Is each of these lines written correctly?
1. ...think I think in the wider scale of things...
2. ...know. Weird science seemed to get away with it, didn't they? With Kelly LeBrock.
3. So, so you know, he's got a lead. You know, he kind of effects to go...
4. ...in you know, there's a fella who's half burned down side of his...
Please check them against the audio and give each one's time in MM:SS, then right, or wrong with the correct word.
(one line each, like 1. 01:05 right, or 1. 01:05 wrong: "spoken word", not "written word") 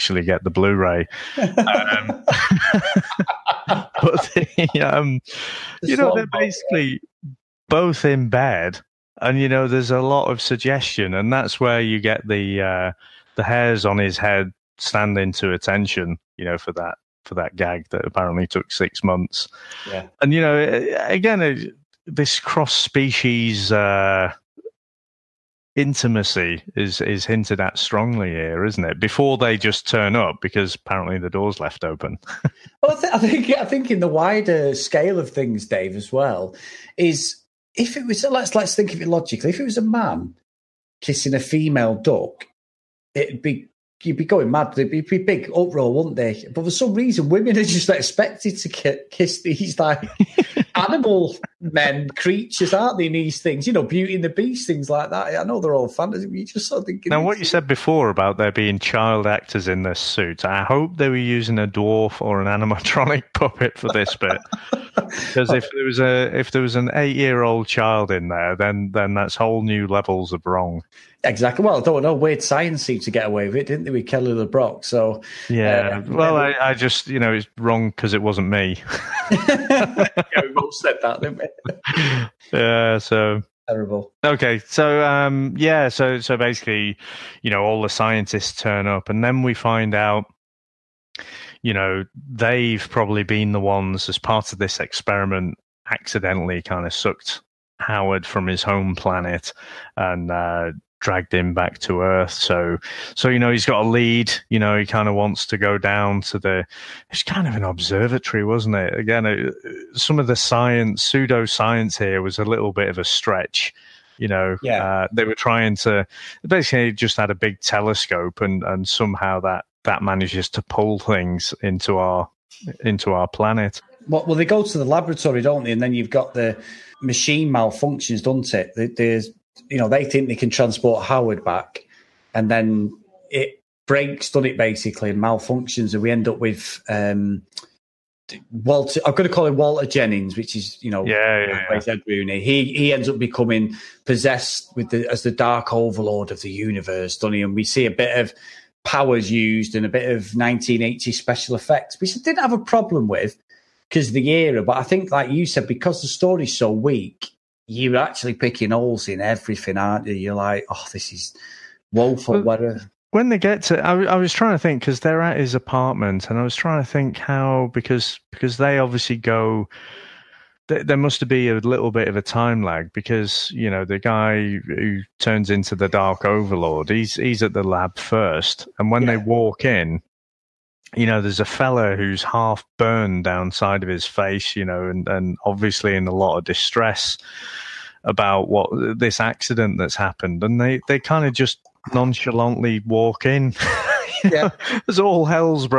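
1. 00:33 right
2. 01:12 right
3. 01:42 wrong: "wants", not "effects"
4. 02:59 right.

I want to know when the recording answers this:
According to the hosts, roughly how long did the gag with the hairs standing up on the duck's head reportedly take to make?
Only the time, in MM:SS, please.
00:18.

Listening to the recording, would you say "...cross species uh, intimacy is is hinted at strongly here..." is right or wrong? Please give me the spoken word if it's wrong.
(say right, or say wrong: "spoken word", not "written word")
right.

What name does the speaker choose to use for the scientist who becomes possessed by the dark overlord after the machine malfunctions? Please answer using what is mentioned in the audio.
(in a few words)
Walter Jennings.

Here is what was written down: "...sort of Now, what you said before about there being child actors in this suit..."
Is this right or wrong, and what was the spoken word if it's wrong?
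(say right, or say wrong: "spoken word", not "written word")
right.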